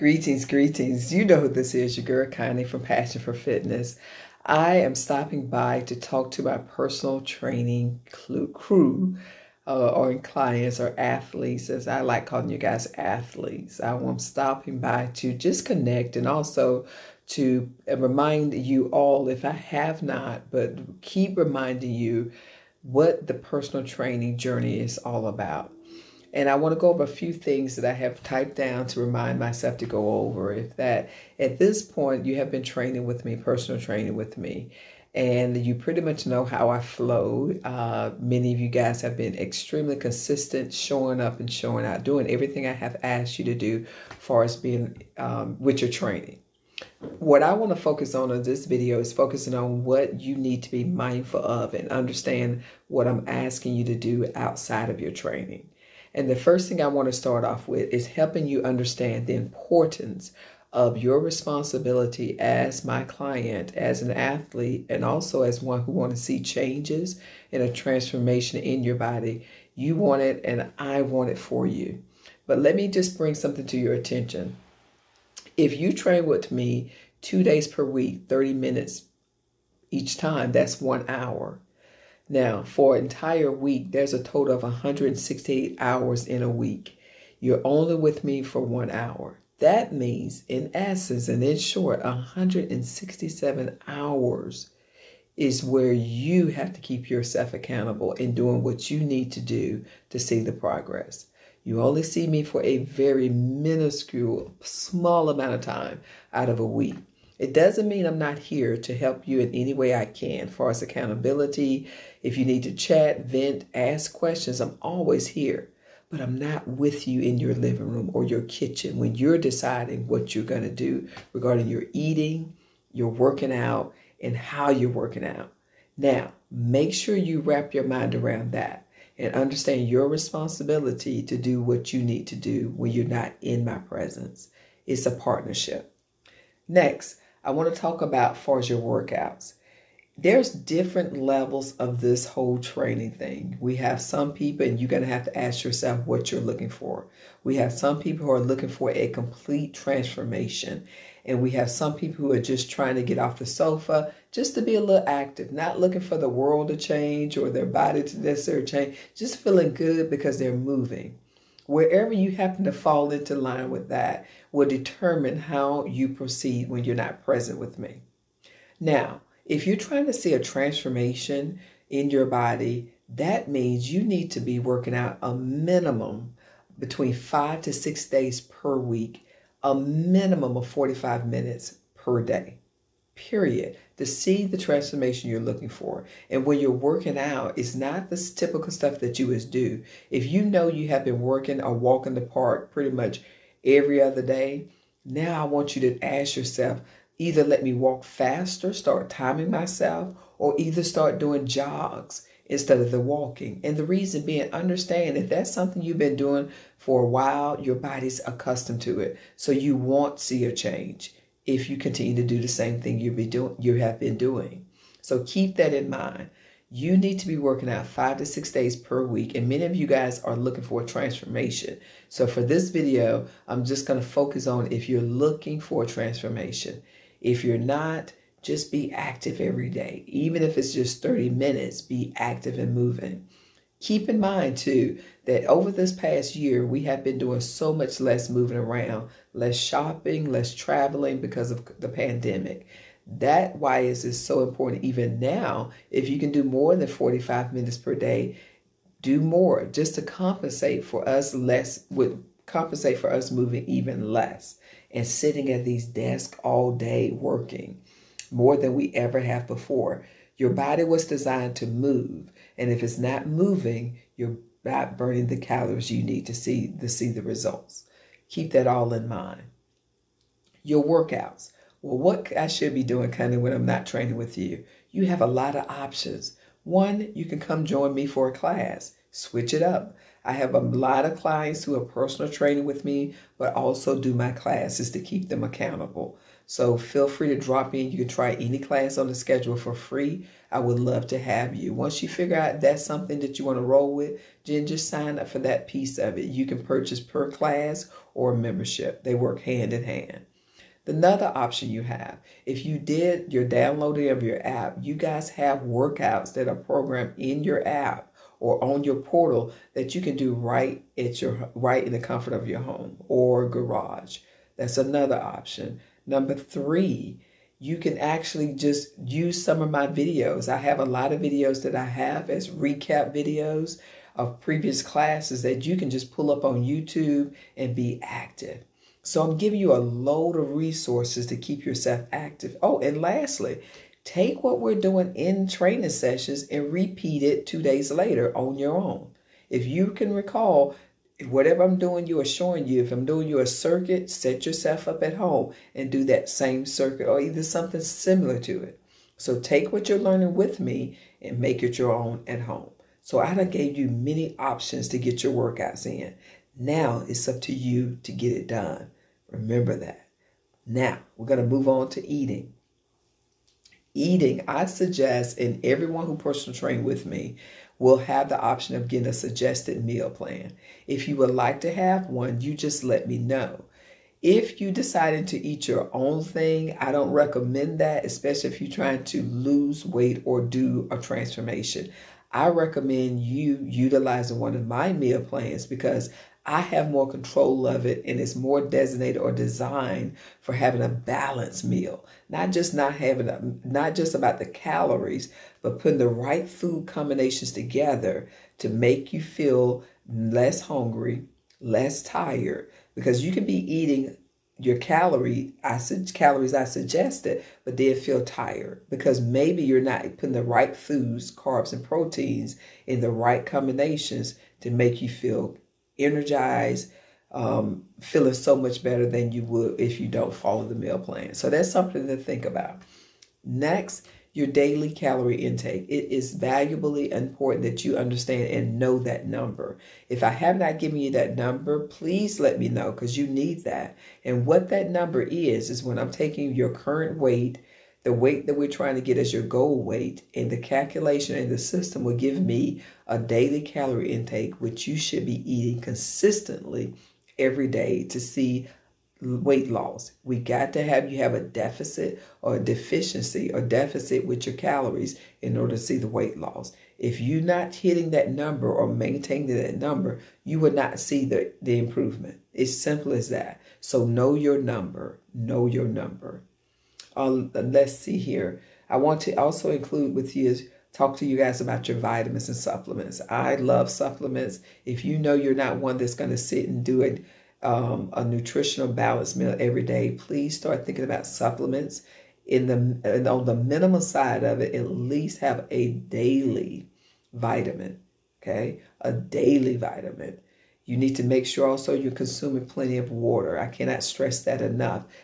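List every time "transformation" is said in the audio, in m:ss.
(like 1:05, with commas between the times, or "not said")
1:07, 2:29, 2:50, 3:04, 3:40, 3:45, 6:20.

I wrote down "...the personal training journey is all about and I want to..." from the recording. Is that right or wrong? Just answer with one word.
right.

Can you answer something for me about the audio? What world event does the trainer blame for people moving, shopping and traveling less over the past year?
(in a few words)
the pandemic.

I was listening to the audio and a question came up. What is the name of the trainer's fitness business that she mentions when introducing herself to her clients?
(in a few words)
Passion for Fitness.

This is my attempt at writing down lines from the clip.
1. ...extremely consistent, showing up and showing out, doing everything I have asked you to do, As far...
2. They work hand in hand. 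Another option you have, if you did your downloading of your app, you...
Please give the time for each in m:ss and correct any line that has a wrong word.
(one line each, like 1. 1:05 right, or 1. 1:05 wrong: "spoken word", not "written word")
1. 0:39 right
2. 4:59 right.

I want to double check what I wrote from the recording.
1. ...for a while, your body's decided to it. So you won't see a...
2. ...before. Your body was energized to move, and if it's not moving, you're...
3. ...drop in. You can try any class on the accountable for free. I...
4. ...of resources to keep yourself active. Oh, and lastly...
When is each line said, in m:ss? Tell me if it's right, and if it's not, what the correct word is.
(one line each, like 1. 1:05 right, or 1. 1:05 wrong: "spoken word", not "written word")
1. 3:26 wrong: "accustomed", not "decided"
2. 4:19 wrong: "designed", not "energized"
3. 4:47 wrong: "schedule", not "accountable"
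4. 5:30 right.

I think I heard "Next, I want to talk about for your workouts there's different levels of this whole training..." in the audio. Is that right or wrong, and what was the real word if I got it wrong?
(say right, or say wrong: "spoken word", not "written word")
right.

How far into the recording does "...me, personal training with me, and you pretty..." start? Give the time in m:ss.
0:33.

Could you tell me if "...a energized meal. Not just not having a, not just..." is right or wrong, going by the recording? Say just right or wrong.
wrong.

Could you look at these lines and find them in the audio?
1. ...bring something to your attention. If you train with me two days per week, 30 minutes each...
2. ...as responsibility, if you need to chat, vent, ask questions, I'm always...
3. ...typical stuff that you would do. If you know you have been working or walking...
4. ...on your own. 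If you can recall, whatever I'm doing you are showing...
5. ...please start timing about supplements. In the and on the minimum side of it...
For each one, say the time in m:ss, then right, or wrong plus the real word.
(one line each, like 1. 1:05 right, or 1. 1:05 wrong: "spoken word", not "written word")
1. 1:13 right
2. 1:50 wrong: "accountability", not "responsibility"
3. 3:08 right
4. 5:38 right
5. 8:00 wrong: "thinking", not "timing".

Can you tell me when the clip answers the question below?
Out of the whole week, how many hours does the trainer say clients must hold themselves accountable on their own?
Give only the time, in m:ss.
1:32.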